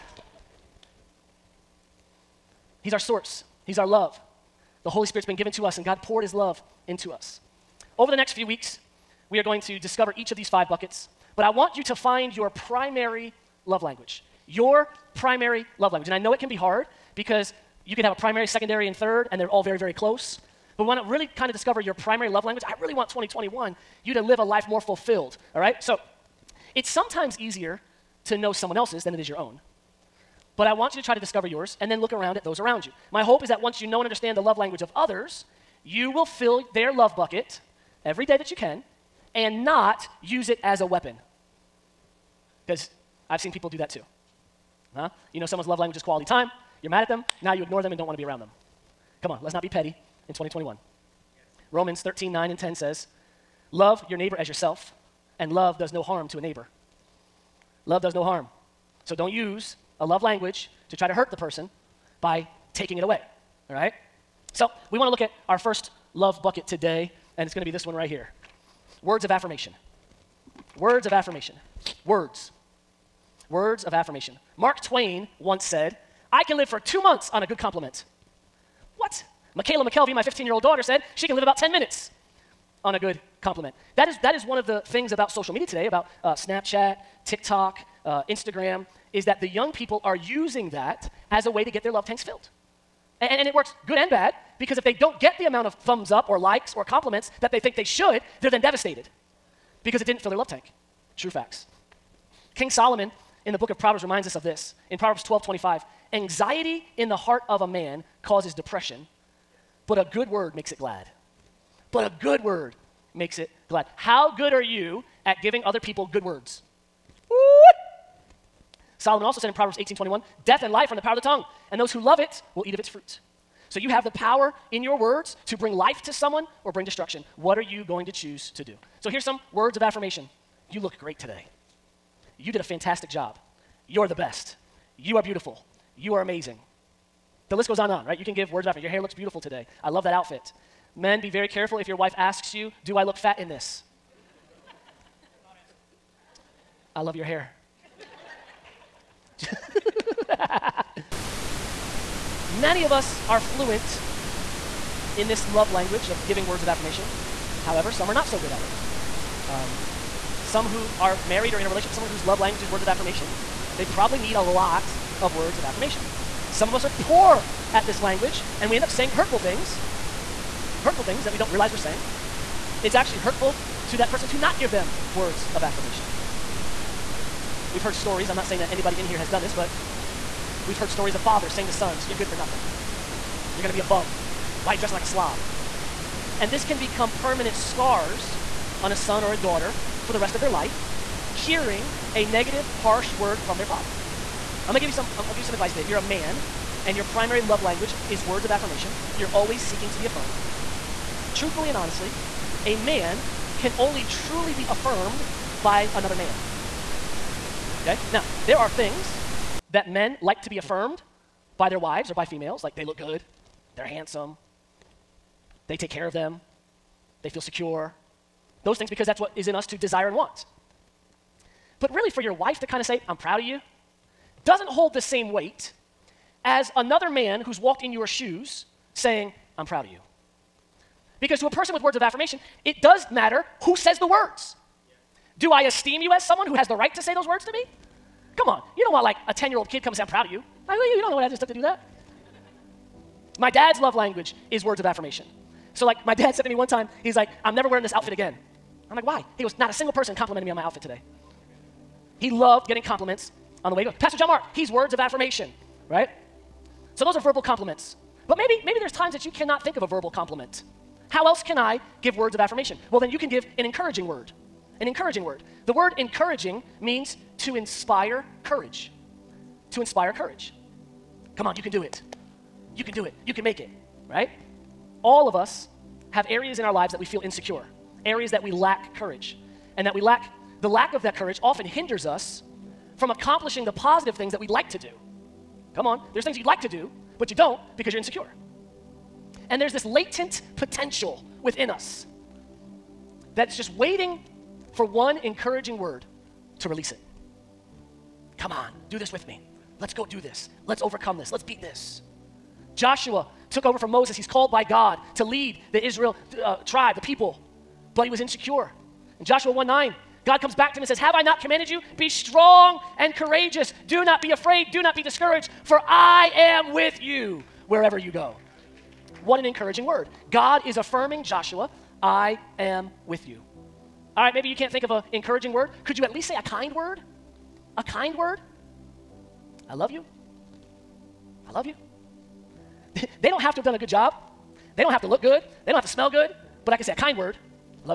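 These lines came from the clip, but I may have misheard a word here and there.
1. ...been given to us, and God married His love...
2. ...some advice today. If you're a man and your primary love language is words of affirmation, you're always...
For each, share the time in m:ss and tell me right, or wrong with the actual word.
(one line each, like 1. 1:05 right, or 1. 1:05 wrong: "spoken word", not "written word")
1. 0:05 wrong: "poured", not "married"
2. 3:15 right.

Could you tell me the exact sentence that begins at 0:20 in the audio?
But we want to really kind of discover your primary love language.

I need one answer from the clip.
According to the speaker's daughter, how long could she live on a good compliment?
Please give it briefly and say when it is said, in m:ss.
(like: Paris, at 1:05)
10 minutes, at 1:21.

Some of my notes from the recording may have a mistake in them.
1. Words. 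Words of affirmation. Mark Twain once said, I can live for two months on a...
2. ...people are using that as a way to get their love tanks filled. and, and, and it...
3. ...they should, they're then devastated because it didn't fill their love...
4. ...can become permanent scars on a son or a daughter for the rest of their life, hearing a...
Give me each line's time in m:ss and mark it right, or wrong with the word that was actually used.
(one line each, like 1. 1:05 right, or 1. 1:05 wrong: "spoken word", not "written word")
1. 1:12 right
2. 1:29 right
3. 1:37 right
4. 3:06 right.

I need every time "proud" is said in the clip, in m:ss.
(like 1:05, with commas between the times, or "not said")
3:43, 3:49, 4:00.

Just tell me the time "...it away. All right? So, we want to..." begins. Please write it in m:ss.
1:02.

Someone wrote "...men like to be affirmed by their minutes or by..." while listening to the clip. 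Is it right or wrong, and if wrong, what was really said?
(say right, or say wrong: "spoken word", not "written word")
wrong: "wives", not "minutes".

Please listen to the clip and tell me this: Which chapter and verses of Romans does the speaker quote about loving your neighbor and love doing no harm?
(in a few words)
Romans 13:9-10.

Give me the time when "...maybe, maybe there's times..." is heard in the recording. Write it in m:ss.
4:18.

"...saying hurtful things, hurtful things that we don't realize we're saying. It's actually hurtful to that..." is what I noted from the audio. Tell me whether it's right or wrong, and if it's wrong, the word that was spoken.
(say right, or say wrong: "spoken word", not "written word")
right.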